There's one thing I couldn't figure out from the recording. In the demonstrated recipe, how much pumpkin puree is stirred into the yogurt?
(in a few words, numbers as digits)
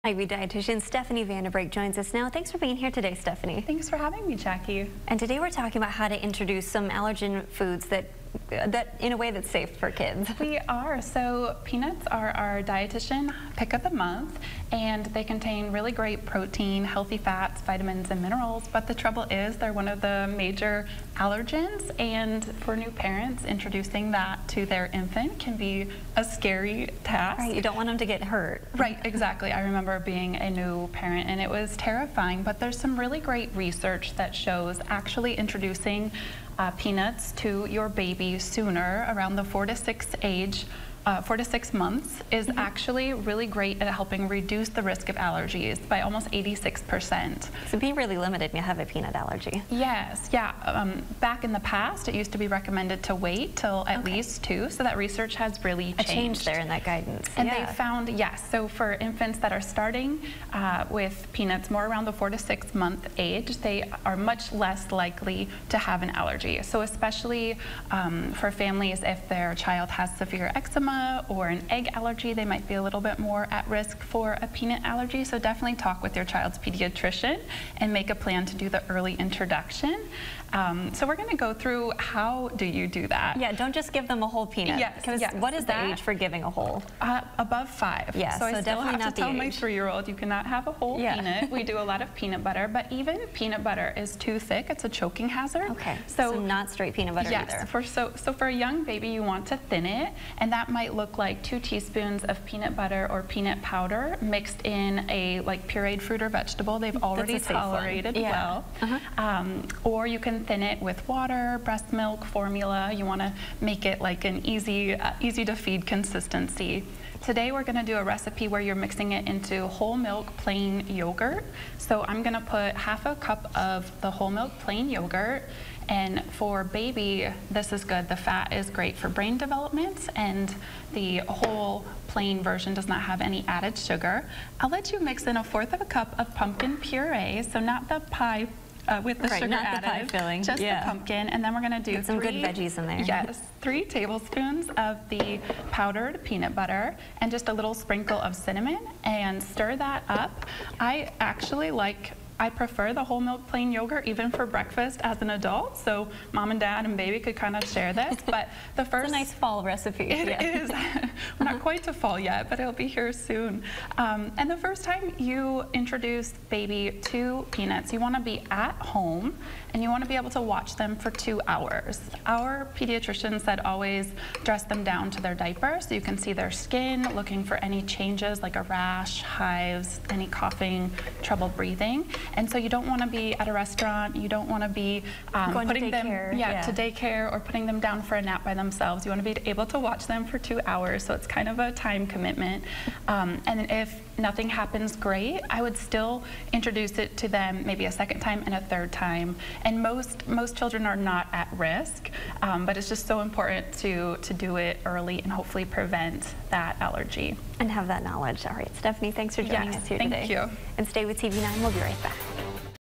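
1/4 cup.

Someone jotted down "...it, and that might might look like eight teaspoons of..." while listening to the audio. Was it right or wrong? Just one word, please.
wrong.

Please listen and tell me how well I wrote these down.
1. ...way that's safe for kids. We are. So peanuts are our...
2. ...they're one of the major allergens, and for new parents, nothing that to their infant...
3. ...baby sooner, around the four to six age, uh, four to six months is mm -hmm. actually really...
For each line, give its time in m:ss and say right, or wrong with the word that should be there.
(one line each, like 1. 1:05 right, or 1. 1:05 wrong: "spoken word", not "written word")
1. 0:09 right
2. 0:19 wrong: "introducing", not "nothing"
3. 0:37 right.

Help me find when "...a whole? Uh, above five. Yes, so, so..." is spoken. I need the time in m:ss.
1:26.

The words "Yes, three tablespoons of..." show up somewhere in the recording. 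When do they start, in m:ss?
2:23.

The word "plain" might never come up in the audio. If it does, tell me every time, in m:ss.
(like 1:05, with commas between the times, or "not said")
2:00, 2:04, 2:12, 2:33.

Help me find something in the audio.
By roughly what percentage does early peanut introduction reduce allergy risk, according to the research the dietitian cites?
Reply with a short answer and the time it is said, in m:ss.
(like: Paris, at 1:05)
86%, at 0:46.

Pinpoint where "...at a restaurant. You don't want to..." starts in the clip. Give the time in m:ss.
3:03.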